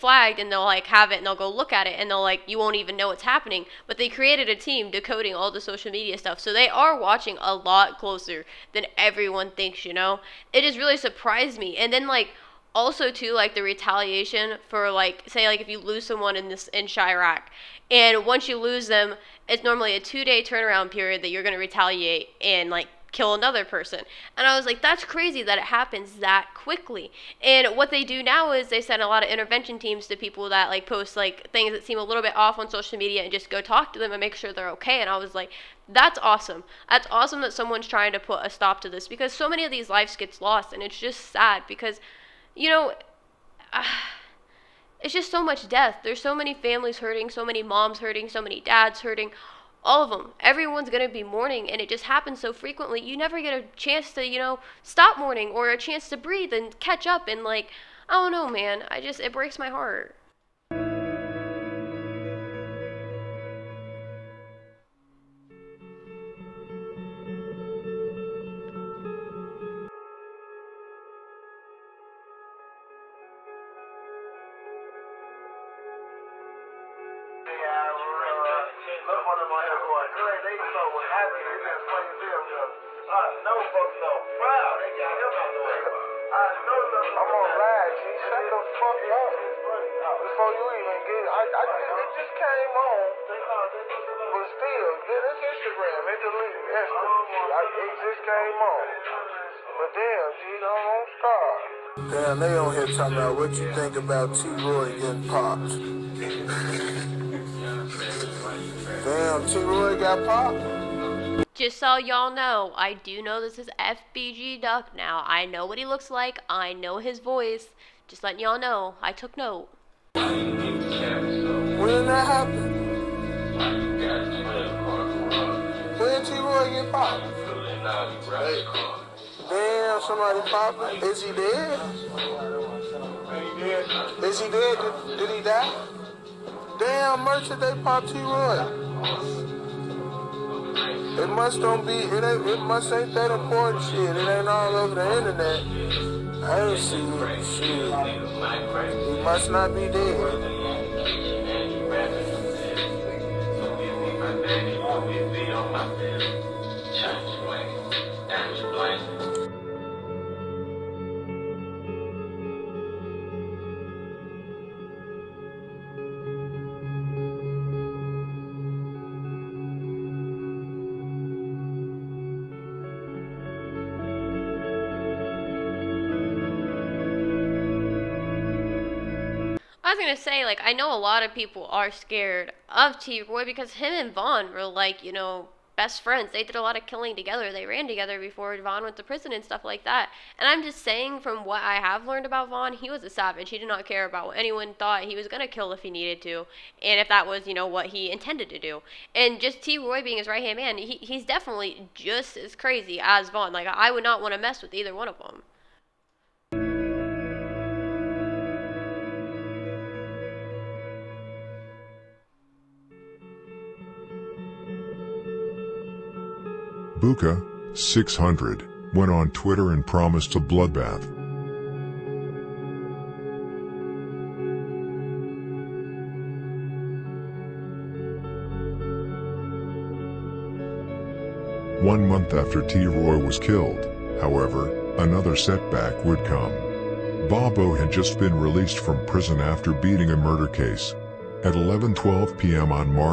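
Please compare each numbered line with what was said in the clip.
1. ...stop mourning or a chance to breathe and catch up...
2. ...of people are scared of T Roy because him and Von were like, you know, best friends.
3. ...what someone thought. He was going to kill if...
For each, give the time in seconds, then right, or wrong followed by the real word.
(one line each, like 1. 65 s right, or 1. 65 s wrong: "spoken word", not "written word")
1. 54 s right
2. 181 s right
3. 194 s wrong: "anyone", not "someone".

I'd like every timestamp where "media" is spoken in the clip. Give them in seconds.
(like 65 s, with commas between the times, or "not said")
5 s, 32 s.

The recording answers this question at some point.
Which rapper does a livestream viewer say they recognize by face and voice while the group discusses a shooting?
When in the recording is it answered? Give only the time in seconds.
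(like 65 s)
113 s.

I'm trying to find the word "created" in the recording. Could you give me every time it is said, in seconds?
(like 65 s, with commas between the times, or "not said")
4 s.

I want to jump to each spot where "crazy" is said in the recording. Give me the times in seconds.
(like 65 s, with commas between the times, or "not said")
25 s, 202 s.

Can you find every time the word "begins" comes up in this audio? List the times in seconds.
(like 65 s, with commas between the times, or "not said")
not said.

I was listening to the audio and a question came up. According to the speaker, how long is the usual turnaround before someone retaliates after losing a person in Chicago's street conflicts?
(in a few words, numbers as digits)
2 days.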